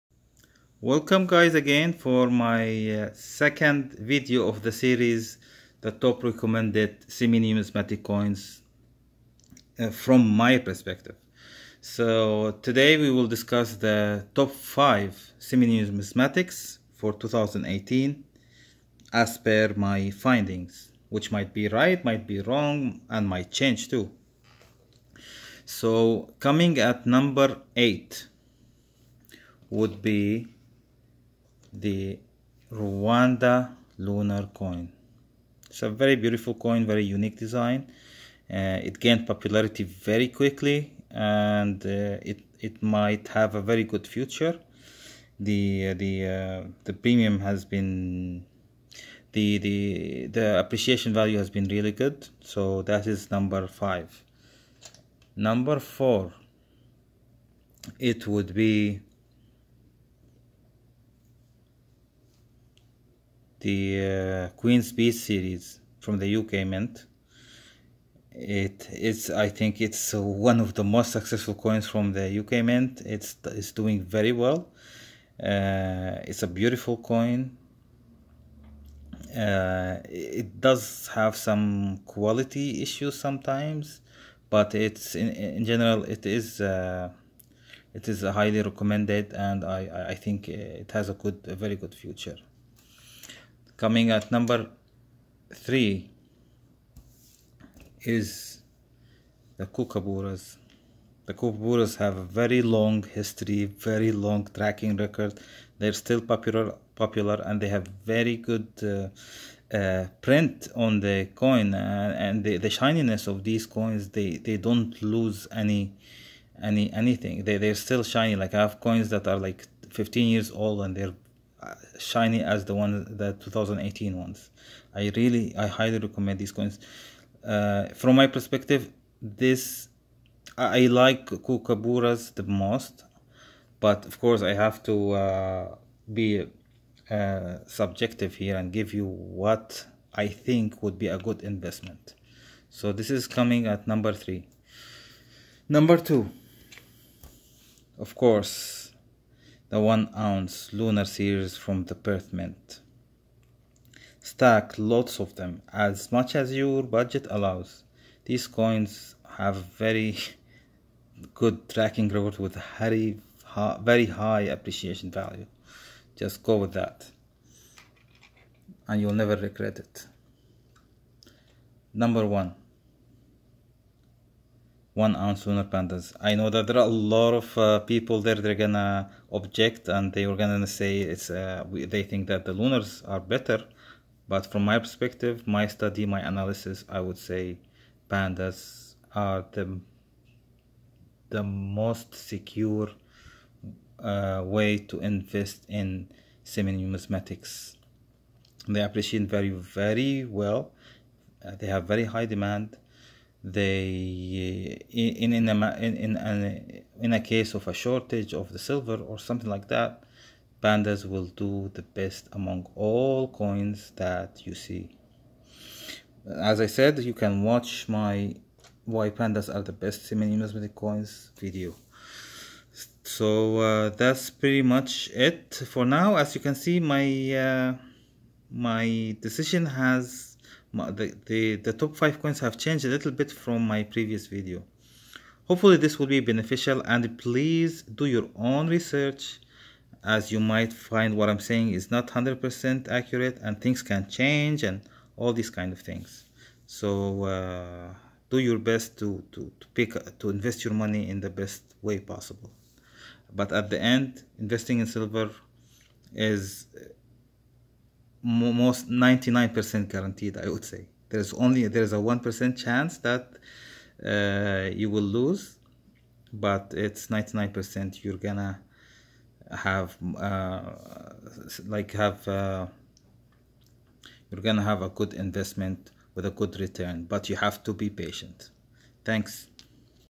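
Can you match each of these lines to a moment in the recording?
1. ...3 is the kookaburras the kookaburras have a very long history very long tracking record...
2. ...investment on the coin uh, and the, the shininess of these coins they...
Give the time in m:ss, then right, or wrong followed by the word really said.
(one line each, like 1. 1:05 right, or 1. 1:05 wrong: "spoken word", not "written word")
1. 1:35 right
2. 1:50 wrong: "print", not "investment".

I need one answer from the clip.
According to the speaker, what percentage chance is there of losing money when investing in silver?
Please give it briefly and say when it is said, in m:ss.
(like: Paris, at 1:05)
1%, at 4:21.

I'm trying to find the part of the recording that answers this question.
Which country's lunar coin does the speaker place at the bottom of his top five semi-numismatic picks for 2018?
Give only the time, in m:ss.
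0:32.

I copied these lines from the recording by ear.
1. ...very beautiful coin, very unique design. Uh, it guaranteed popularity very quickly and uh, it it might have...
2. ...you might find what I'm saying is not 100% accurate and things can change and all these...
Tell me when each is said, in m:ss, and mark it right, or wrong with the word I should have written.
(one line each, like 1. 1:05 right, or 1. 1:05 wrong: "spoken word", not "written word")
1. 0:35 wrong: "gained", not "guaranteed"
2. 4:00 right.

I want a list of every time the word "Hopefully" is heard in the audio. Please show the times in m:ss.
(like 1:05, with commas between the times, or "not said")
3:55.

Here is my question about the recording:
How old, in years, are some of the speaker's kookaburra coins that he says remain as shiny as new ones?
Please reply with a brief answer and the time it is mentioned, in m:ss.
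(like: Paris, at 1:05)
15, at 1:59.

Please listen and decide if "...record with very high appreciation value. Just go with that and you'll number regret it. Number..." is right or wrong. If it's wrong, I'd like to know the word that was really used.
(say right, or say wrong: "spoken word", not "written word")
wrong: "never", not "number".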